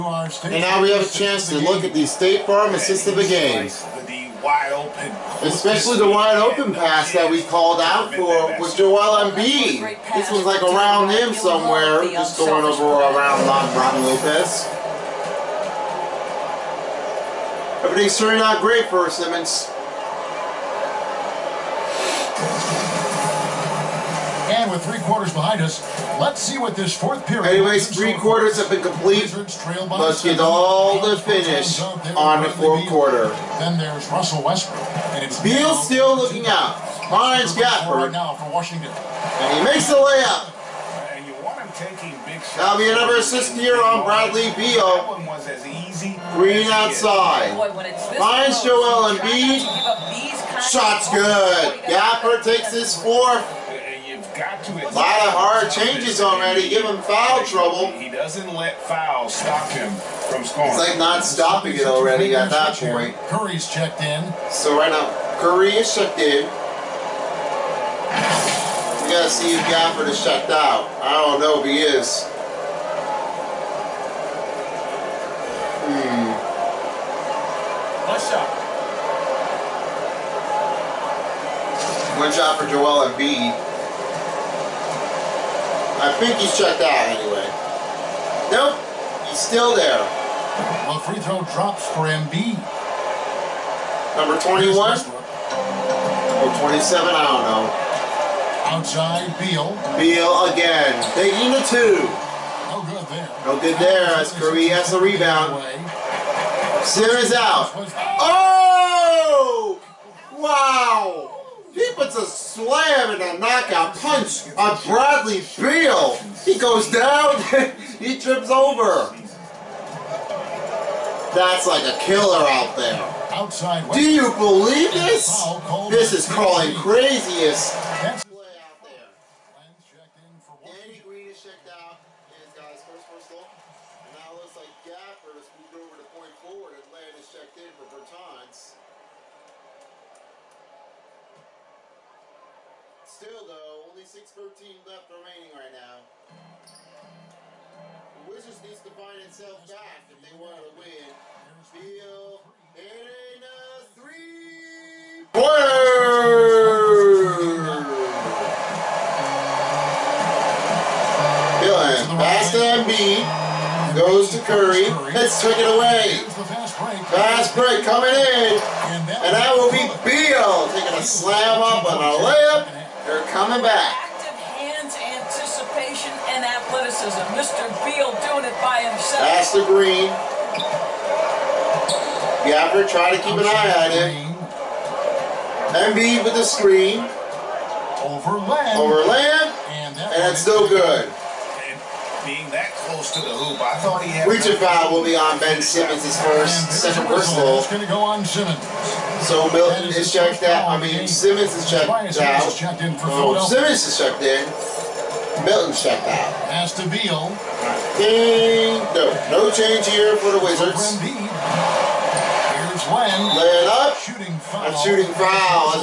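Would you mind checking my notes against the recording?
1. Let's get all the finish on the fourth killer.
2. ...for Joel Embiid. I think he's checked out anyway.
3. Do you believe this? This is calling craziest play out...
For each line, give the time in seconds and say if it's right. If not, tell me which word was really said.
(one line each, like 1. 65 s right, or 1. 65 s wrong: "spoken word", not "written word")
1. 29 s wrong: "quarter", not "killer"
2. 82 s right
3. 123 s right.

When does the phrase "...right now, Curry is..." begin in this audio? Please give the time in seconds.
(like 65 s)
64 s.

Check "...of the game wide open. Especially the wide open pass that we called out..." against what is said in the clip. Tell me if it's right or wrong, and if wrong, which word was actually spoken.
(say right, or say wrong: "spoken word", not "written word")
right.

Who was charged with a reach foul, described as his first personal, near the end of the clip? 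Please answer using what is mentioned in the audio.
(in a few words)
Ben Simmons.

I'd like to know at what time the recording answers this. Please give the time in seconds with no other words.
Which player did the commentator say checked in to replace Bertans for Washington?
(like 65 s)
136 s.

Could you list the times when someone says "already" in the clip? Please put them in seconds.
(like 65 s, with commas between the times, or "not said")
56 s, 61 s.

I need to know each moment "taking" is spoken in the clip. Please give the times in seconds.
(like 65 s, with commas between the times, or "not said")
41 s, 101 s, 170 s.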